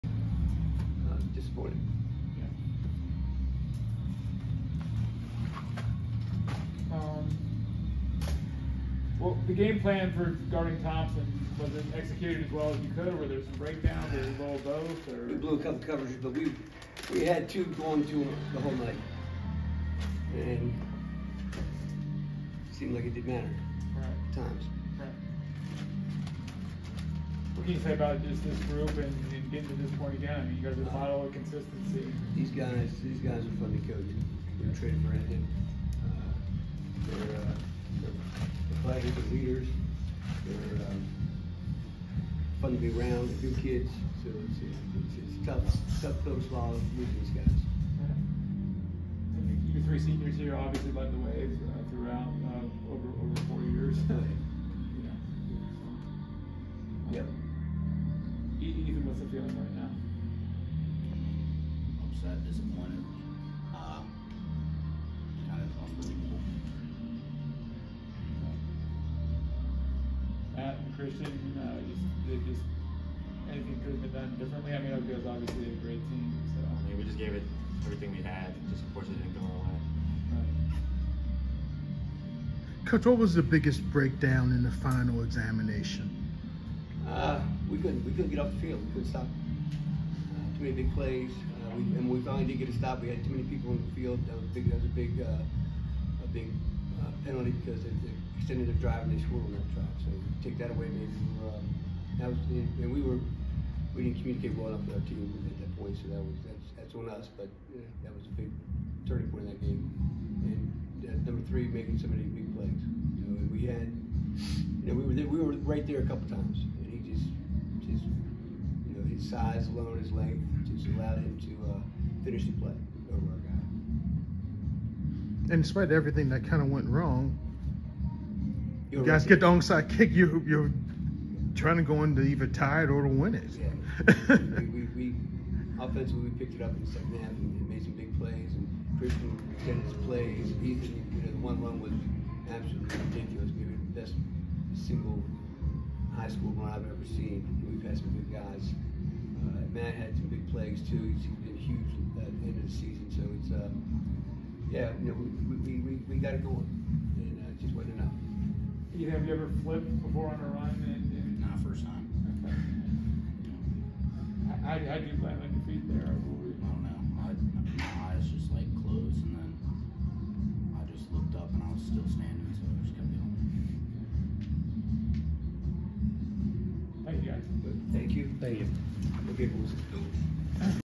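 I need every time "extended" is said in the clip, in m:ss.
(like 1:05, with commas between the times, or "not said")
1:38, 2:19.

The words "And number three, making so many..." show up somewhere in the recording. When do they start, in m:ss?
1:50.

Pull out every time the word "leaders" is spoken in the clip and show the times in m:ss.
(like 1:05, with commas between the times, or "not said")
0:39.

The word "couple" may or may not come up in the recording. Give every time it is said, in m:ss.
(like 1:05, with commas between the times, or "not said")
0:15, 1:56.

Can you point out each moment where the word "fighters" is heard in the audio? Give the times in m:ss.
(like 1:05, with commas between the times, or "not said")
0:38.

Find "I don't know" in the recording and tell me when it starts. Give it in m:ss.
2:46.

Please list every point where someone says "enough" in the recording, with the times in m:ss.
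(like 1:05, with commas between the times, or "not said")
1:44, 2:37.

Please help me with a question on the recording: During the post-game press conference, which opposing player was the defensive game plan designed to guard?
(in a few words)
Thompson.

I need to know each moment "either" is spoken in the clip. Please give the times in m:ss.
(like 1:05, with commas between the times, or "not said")
2:12, 2:38.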